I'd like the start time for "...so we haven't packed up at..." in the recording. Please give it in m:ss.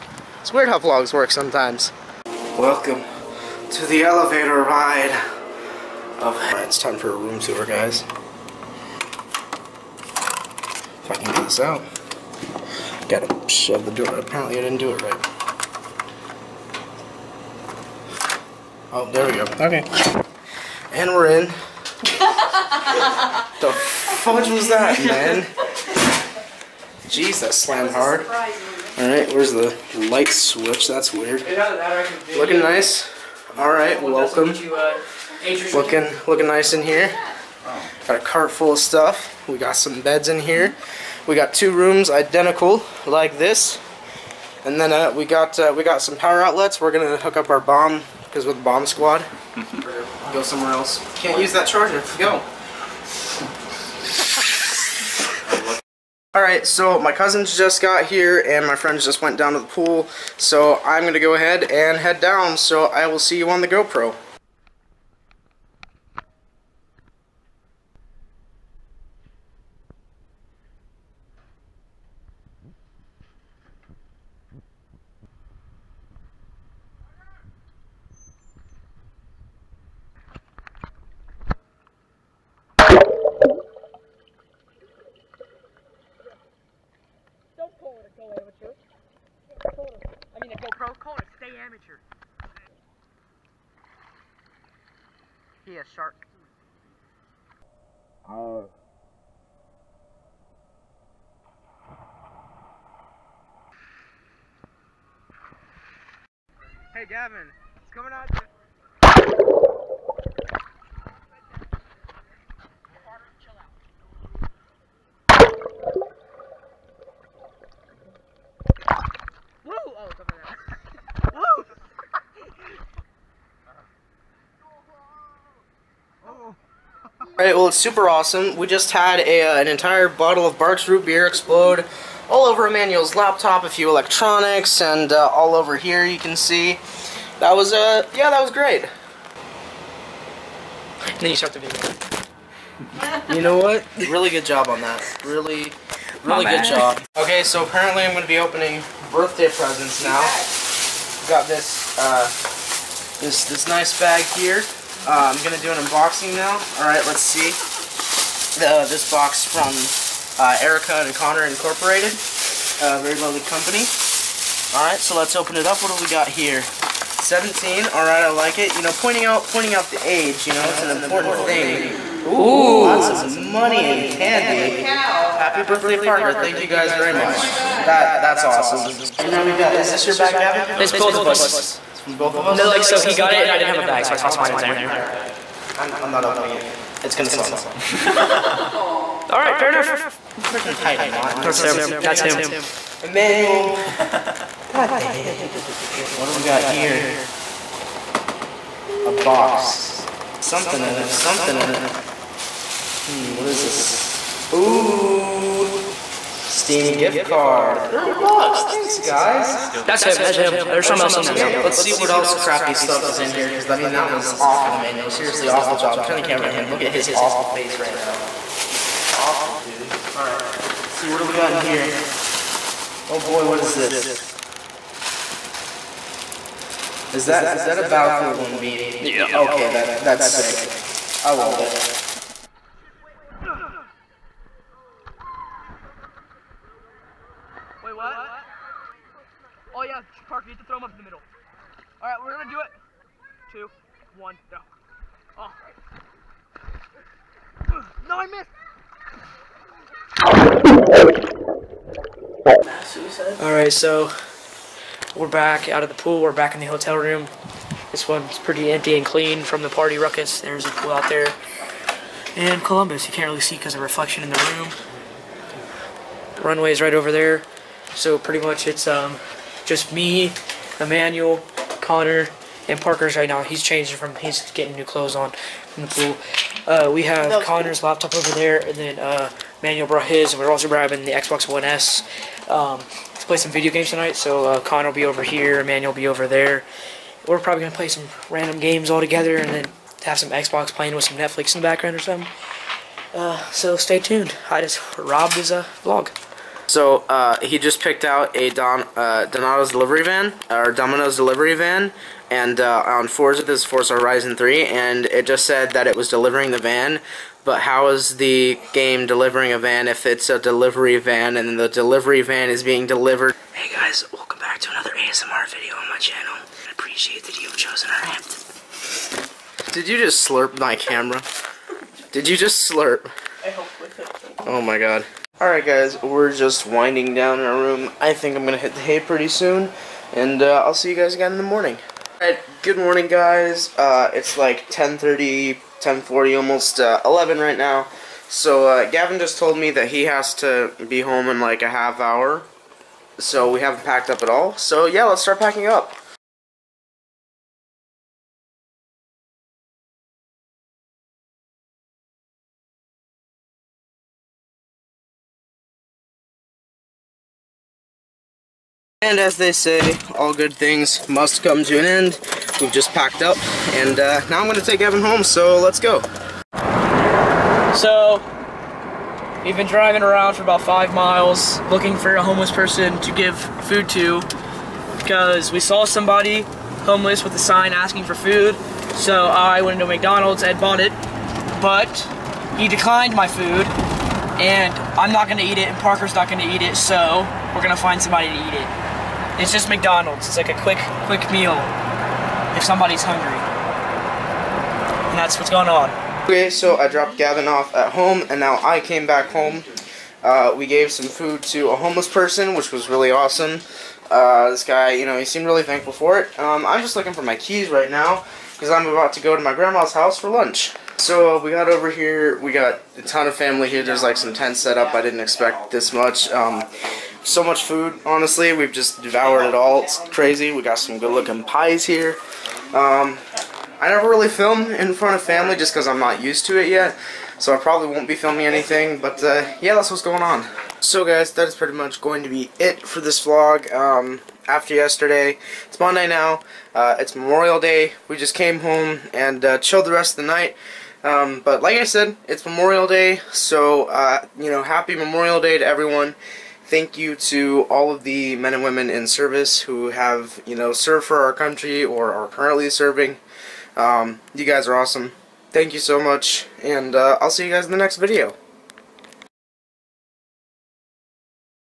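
5:43.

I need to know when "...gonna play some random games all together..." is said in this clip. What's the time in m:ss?
4:47.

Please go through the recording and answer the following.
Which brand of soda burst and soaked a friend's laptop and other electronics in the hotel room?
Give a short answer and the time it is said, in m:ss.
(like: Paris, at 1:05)
Barq's Root Beer, at 2:10.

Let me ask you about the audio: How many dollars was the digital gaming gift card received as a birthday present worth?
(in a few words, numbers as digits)
30.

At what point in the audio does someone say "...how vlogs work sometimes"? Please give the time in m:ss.
0:00.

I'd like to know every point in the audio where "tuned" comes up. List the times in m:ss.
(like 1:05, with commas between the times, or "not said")
4:53.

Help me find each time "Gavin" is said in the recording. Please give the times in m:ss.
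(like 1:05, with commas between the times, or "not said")
1:47, 3:00, 5:38, 6:37.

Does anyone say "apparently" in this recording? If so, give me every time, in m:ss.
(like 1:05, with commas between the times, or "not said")
0:14, 2:27.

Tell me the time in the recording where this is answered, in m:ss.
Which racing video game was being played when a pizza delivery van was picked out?
5:03.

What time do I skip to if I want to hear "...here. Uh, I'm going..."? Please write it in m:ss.
2:34.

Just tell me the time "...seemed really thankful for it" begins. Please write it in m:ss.
6:45.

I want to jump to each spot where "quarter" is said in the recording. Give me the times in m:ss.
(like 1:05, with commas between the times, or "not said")
not said.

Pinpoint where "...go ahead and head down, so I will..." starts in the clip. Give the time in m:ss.
1:01.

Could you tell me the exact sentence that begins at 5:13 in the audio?
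Hey guys, welcome back to another ASMR video on my channel.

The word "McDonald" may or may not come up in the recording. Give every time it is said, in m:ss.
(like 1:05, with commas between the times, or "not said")
6:19, 6:29.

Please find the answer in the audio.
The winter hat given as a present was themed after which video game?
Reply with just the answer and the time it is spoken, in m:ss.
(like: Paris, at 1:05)
Battlefield 1, at 3:47.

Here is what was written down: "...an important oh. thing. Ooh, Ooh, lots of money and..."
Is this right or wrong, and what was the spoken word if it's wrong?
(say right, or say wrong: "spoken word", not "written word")
right.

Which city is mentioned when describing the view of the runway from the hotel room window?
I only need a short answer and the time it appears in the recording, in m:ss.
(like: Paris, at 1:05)
Columbus, at 4:22.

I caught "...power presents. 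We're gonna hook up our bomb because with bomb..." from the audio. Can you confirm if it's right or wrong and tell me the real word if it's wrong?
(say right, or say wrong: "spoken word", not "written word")
wrong: "outlets", not "presents".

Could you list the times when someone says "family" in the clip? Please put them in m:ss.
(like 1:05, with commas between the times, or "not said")
6:53, 7:05.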